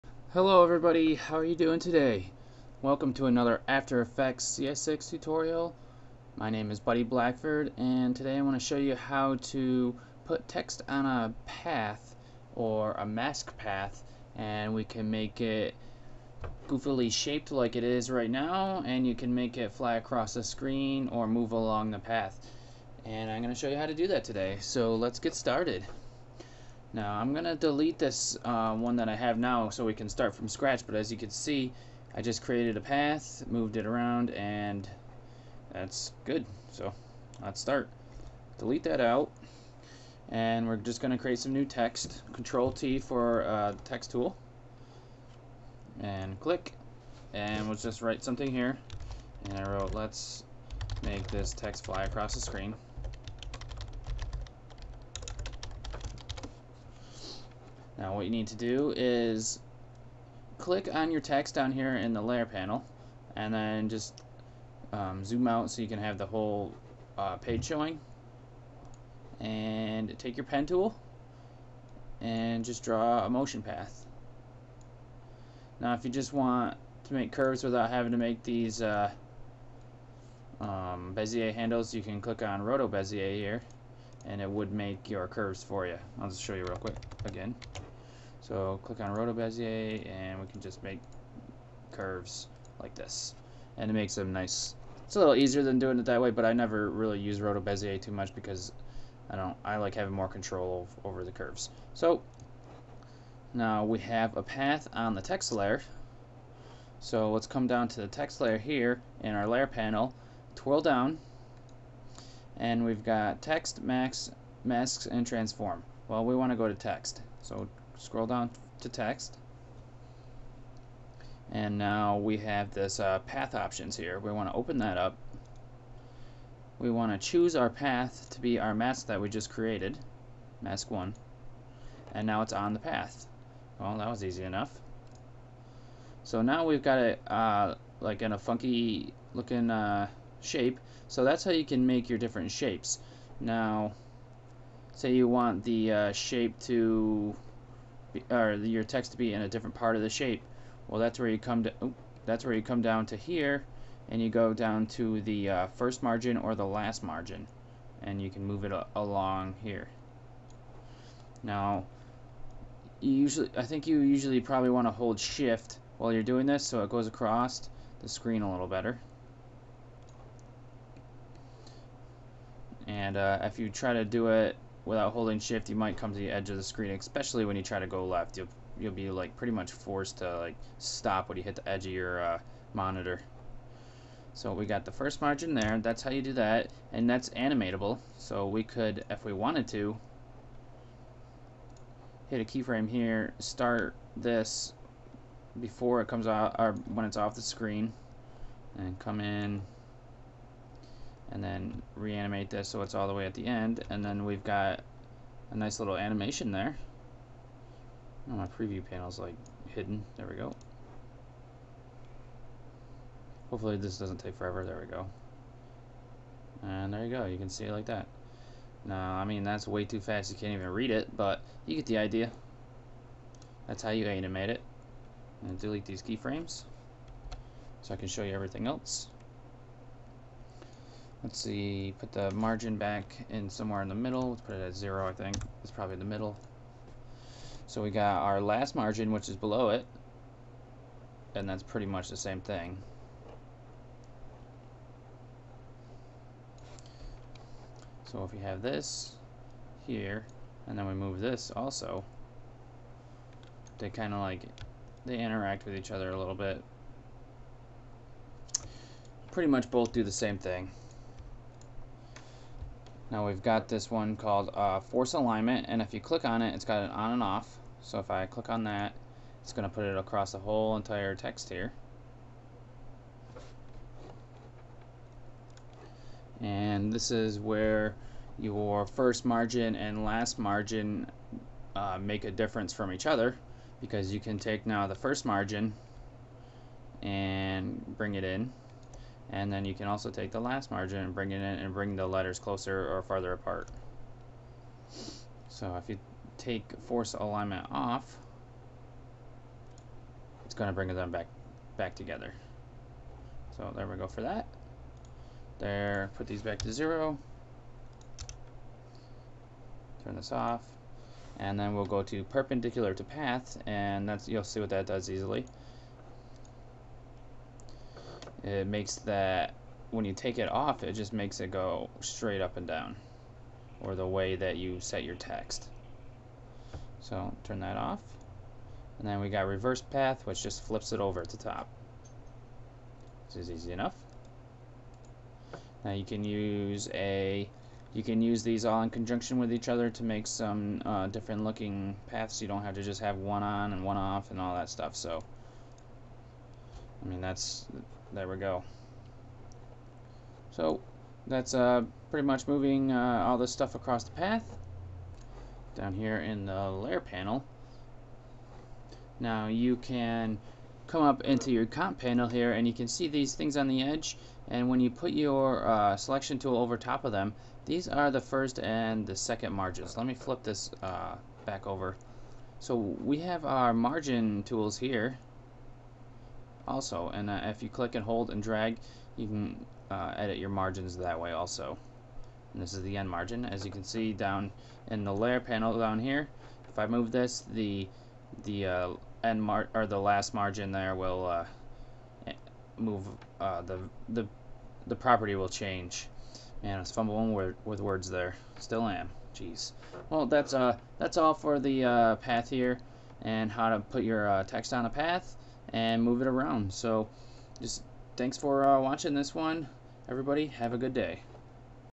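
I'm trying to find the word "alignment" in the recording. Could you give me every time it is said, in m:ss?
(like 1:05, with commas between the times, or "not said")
4:25, 4:57.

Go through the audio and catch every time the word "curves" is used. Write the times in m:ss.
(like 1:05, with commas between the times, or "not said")
1:17, 1:25, 1:31, 1:41.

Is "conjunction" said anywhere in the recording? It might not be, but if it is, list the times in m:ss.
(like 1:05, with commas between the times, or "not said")
5:38.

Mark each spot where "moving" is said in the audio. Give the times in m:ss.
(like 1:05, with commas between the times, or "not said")
5:52.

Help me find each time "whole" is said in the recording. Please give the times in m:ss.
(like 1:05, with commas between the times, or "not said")
1:06, 4:30.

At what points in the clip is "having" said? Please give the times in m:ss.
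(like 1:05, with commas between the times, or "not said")
1:17, 1:39.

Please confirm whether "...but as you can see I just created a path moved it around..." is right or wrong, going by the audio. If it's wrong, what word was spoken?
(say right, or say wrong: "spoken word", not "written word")
right.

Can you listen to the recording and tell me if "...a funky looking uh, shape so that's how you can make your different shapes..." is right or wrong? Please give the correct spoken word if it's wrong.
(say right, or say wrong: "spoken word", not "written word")
right.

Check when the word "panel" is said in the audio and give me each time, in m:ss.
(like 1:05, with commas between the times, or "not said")
1:02, 1:49, 3:28, 5:56, 6:01, 6:25.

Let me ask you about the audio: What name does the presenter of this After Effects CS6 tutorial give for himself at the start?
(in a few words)
Buddy Blackford.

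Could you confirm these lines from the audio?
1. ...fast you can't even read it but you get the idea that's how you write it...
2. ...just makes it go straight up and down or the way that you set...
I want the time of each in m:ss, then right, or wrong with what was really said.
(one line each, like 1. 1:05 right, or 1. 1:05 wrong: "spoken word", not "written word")
1. 3:40 wrong: "animate", not "write"
2. 5:20 right.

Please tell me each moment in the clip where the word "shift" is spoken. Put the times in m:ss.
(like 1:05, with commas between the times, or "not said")
2:45, 2:55.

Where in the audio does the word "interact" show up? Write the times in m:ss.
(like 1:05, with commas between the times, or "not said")
4:15.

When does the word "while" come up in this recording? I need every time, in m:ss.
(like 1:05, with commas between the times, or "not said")
2:45.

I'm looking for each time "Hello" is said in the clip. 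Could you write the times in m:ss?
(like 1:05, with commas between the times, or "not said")
0:00.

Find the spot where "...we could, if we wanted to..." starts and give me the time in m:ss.
3:08.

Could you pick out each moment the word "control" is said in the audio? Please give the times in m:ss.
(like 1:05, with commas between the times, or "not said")
0:42, 1:40.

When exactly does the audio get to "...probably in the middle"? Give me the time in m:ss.
3:55.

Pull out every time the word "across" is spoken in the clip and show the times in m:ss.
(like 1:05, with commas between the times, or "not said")
0:19, 0:52, 2:47, 4:29, 5:53.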